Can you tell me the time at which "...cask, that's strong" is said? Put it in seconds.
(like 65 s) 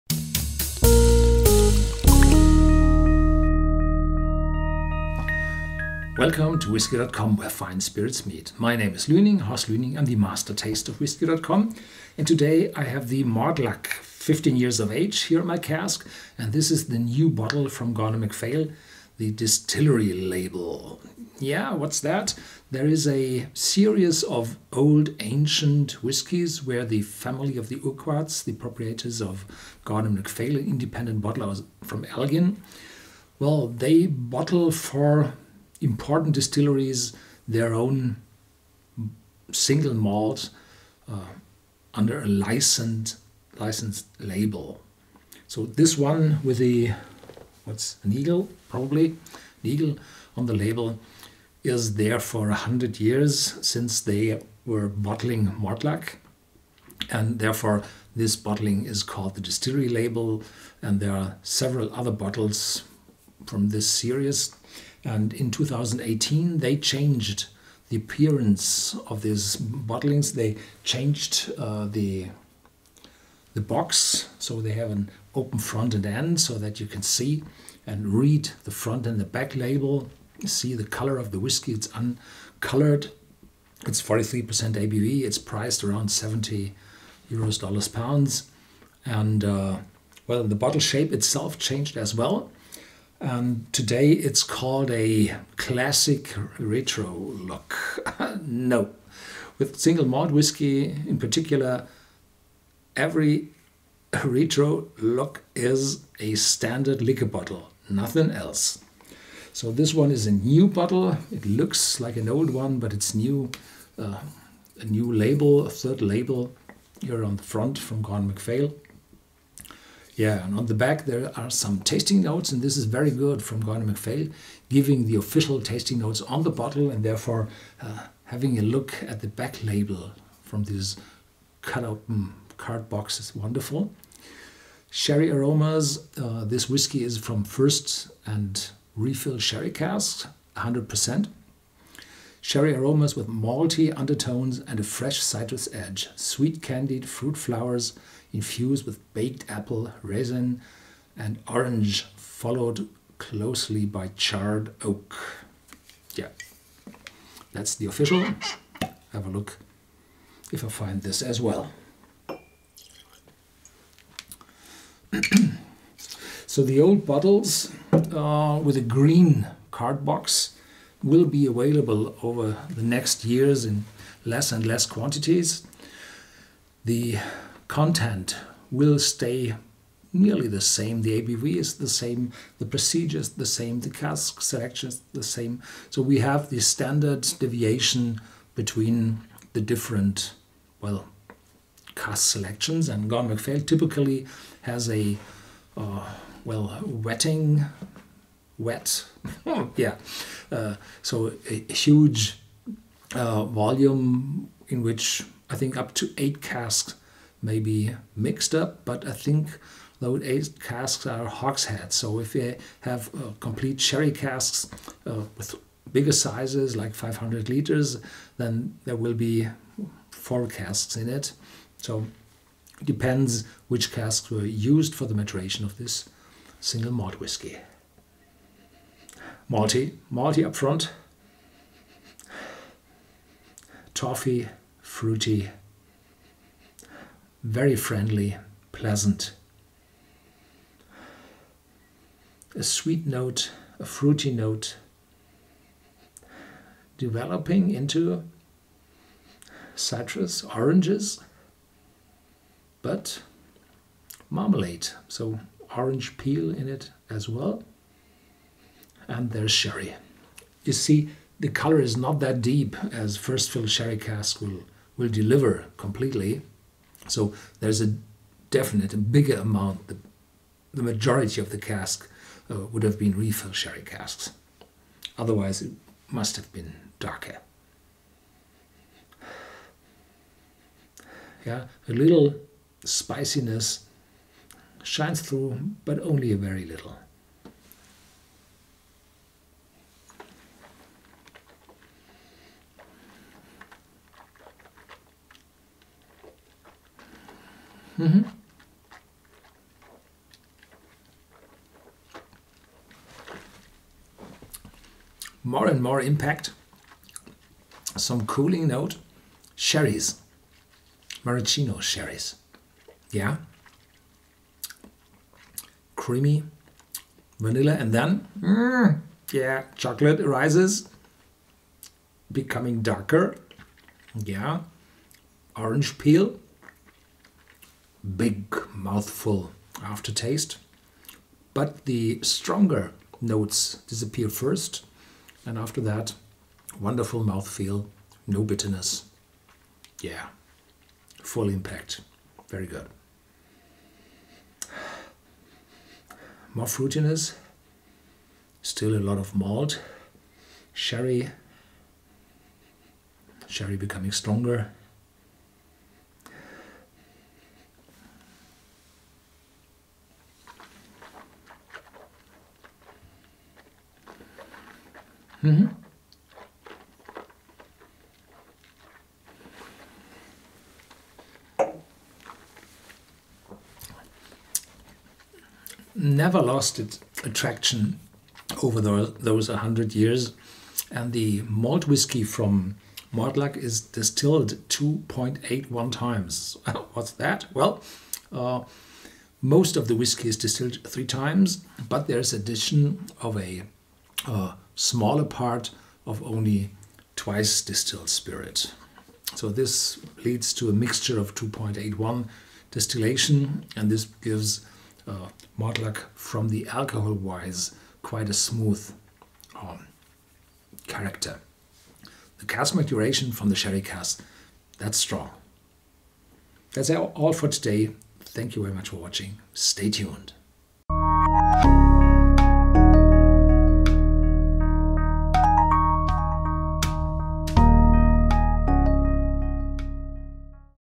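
413 s.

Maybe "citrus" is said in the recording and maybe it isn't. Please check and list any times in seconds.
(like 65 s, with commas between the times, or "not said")
145 s, 249 s.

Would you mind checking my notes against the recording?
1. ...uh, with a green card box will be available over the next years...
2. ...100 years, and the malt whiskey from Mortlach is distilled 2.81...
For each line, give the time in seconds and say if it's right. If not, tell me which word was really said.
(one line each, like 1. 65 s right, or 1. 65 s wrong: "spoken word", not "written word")
1. 167 s right
2. 379 s right.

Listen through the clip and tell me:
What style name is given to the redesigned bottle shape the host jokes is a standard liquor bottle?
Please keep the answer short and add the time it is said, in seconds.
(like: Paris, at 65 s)
classic retro look, at 95 s.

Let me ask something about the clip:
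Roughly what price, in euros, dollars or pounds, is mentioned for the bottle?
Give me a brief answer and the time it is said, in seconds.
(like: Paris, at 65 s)
70, at 86 s.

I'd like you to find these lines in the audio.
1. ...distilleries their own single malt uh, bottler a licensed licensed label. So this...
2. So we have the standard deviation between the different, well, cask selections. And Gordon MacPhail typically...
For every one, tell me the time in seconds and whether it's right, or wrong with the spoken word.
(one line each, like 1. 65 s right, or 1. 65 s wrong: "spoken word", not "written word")
1. 36 s wrong: "under", not "bottler"
2. 185 s right.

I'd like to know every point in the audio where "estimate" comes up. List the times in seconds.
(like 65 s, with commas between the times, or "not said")
not said.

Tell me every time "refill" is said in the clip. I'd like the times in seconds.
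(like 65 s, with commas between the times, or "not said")
138 s, 273 s.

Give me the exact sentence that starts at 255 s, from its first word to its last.
So orange peel in it as well and there's sherry.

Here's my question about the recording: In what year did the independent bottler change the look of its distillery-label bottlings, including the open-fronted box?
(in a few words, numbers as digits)
2018.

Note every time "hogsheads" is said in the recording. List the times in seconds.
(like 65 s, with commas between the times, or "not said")
211 s.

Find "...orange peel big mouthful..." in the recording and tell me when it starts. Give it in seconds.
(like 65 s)
325 s.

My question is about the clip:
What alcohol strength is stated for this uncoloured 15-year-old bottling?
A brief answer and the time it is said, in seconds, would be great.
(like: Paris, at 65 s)
43%, at 84 s.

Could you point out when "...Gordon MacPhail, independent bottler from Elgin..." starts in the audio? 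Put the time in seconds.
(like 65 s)
29 s.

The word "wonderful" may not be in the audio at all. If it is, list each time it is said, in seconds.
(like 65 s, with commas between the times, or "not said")
133 s, 336 s.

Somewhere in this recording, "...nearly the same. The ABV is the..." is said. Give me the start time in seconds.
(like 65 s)
180 s.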